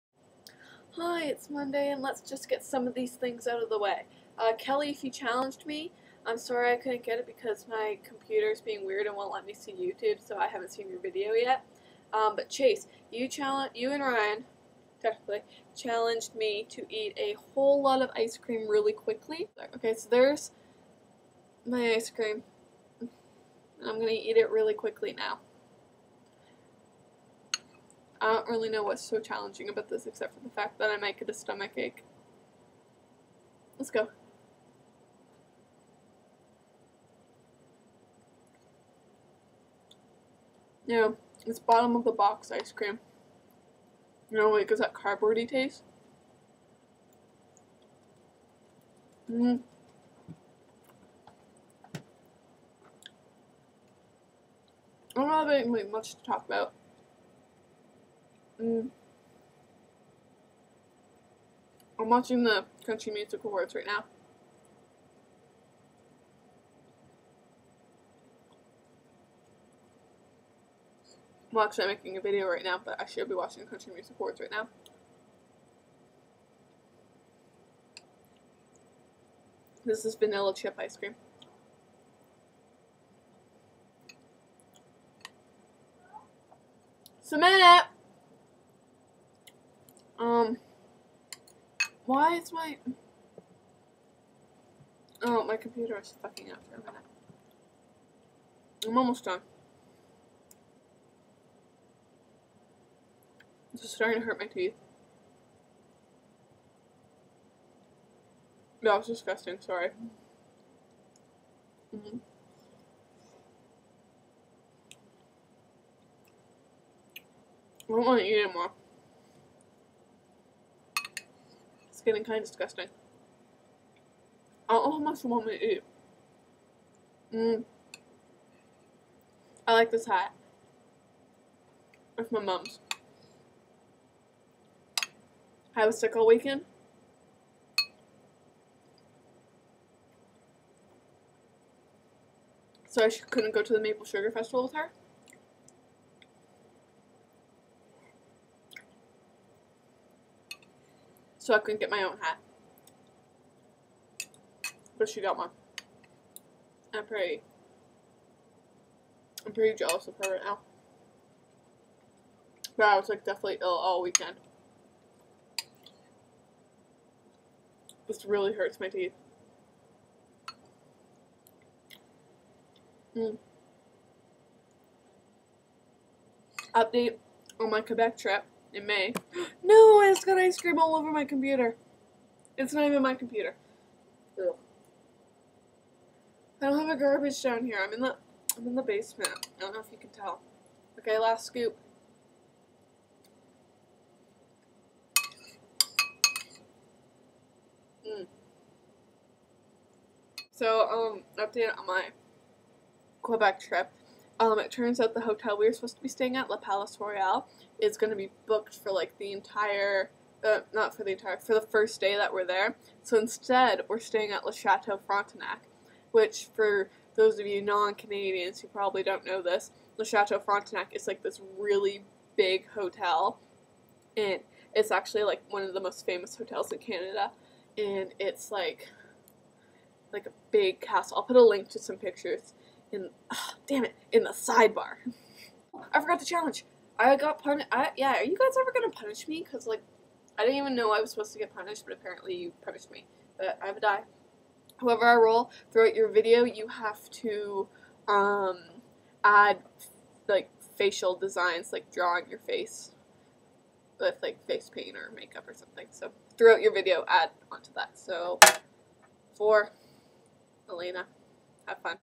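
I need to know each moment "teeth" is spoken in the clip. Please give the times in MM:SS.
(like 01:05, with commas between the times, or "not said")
01:44, 02:48.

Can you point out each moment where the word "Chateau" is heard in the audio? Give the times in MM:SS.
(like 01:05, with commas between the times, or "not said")
03:34, 03:40.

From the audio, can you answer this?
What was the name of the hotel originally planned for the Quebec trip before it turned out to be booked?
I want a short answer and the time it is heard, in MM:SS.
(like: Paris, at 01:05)
La Palace Royale, at 03:26.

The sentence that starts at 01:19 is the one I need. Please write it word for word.
This is vanilla chip ice cream.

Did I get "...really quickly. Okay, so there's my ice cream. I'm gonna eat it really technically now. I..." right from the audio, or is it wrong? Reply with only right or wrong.
wrong.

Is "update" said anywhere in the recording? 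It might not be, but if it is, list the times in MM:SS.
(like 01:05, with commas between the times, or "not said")
02:56, 03:21.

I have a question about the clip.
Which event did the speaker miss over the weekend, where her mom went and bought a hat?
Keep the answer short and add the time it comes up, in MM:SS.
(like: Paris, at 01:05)
Maple Sugar Festival, at 02:23.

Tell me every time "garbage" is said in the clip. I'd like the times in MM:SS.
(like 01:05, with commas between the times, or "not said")
03:07.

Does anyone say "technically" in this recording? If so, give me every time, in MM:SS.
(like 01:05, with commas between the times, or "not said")
00:15.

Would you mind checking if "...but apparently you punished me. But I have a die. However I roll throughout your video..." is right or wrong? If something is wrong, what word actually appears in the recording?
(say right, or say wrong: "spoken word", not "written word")
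right.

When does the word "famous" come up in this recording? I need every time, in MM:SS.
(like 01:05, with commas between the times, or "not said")
03:46.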